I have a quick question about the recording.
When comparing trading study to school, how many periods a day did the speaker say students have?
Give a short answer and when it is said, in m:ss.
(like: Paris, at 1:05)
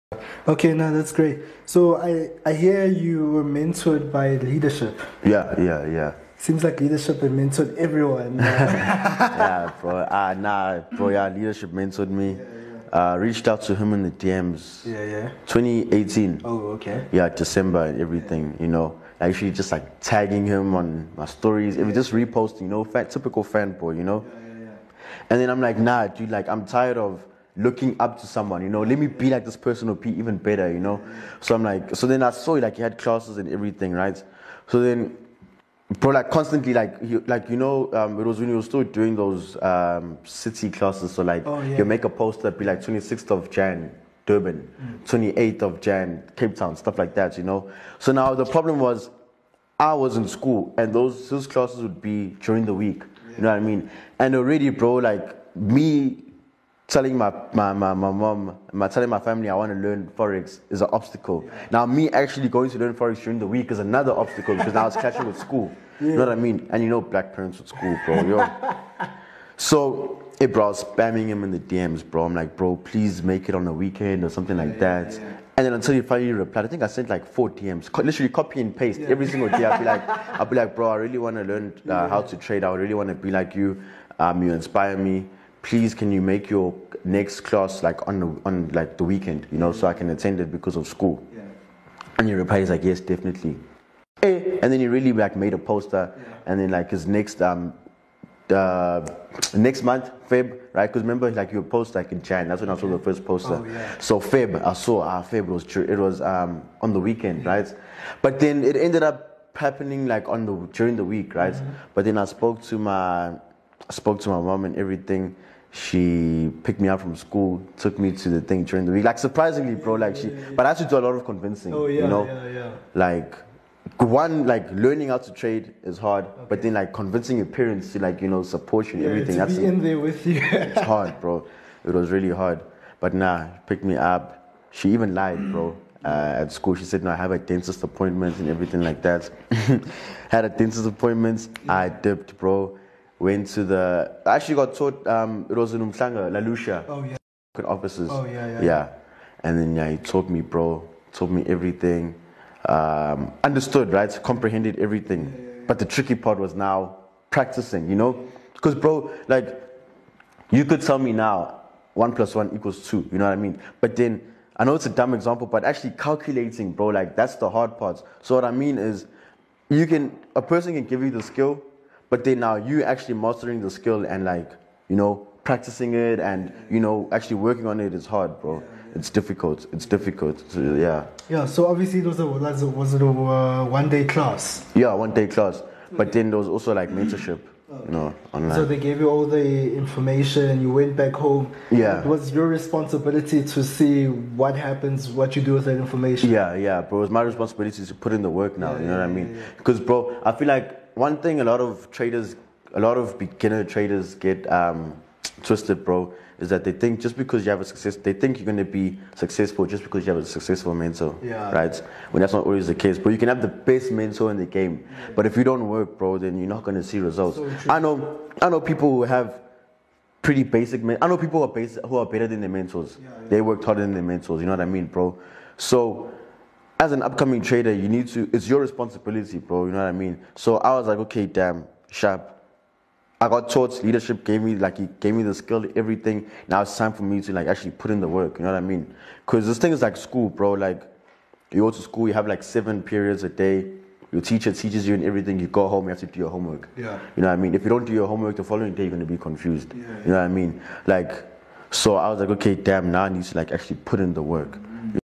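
7, at 4:02.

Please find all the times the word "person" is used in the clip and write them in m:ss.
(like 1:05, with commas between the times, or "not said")
0:29, 2:50.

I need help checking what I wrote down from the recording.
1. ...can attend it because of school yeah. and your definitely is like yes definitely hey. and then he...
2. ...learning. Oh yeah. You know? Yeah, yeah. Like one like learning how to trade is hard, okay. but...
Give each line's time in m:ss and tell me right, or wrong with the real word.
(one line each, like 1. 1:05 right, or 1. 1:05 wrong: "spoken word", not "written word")
1. 1:29 wrong: "reply", not "definitely"
2. 2:01 wrong: "convincing", not "learning".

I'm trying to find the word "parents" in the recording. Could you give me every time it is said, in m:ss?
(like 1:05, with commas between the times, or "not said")
1:07, 2:07.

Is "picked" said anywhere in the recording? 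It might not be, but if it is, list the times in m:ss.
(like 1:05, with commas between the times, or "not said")
1:56, 2:13.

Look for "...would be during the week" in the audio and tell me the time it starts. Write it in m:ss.
0:51.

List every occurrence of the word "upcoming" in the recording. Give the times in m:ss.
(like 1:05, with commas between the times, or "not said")
3:47.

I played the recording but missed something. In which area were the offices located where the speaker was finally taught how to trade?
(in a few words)
Umhlanga, La Lucia.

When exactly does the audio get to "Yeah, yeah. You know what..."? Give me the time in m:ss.
4:09.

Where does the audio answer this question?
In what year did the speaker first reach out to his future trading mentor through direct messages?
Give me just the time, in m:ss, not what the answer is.
0:15.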